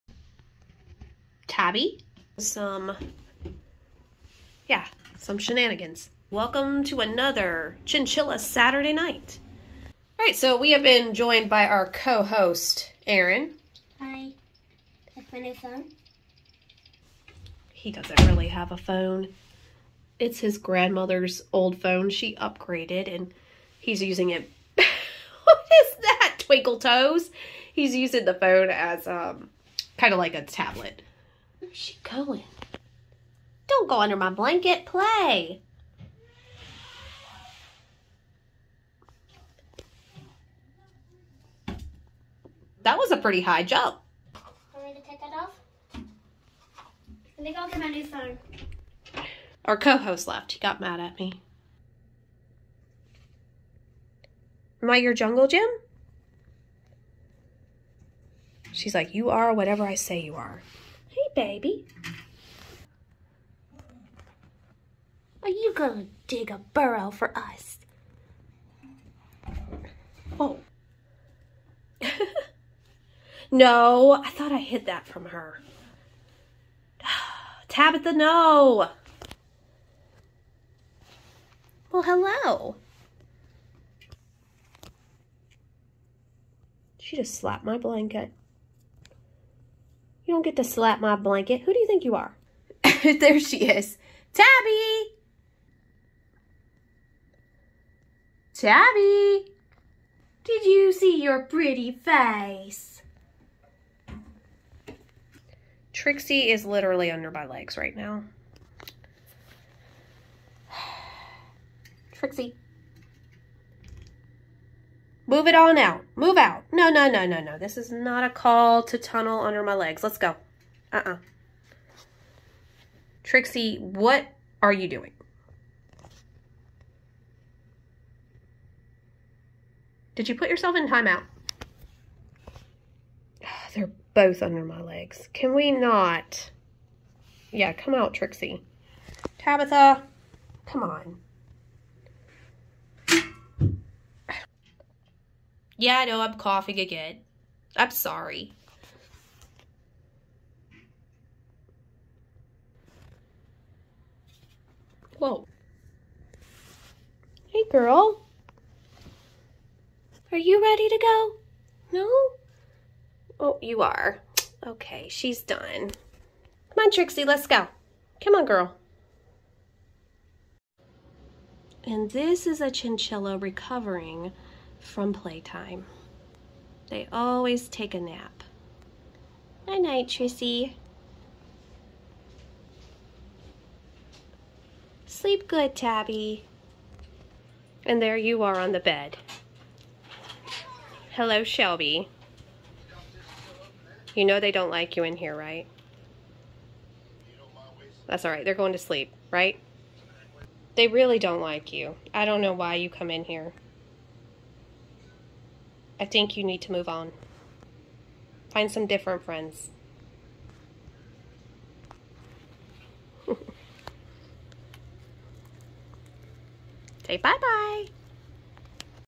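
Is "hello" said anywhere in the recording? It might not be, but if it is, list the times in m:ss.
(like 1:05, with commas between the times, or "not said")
1:22, 3:11.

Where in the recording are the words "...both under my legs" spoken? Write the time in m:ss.
2:14.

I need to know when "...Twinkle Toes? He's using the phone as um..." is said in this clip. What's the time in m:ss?
0:26.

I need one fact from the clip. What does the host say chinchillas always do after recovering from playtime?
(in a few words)
Take a nap.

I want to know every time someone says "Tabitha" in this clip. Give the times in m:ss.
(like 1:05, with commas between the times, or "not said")
1:17, 2:19.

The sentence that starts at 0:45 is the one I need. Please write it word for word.
I think I'll get my new phone.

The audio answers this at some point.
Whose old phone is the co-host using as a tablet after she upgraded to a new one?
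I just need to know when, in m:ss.
0:20.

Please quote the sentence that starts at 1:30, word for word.
You don't get to slap my blanket.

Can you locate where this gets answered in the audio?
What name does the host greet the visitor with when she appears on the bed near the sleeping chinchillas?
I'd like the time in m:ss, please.
3:11.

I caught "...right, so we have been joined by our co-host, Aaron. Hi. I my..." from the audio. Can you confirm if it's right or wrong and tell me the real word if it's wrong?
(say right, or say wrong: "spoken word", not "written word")
right.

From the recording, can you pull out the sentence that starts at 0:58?
She's like, you are whatever I say you are.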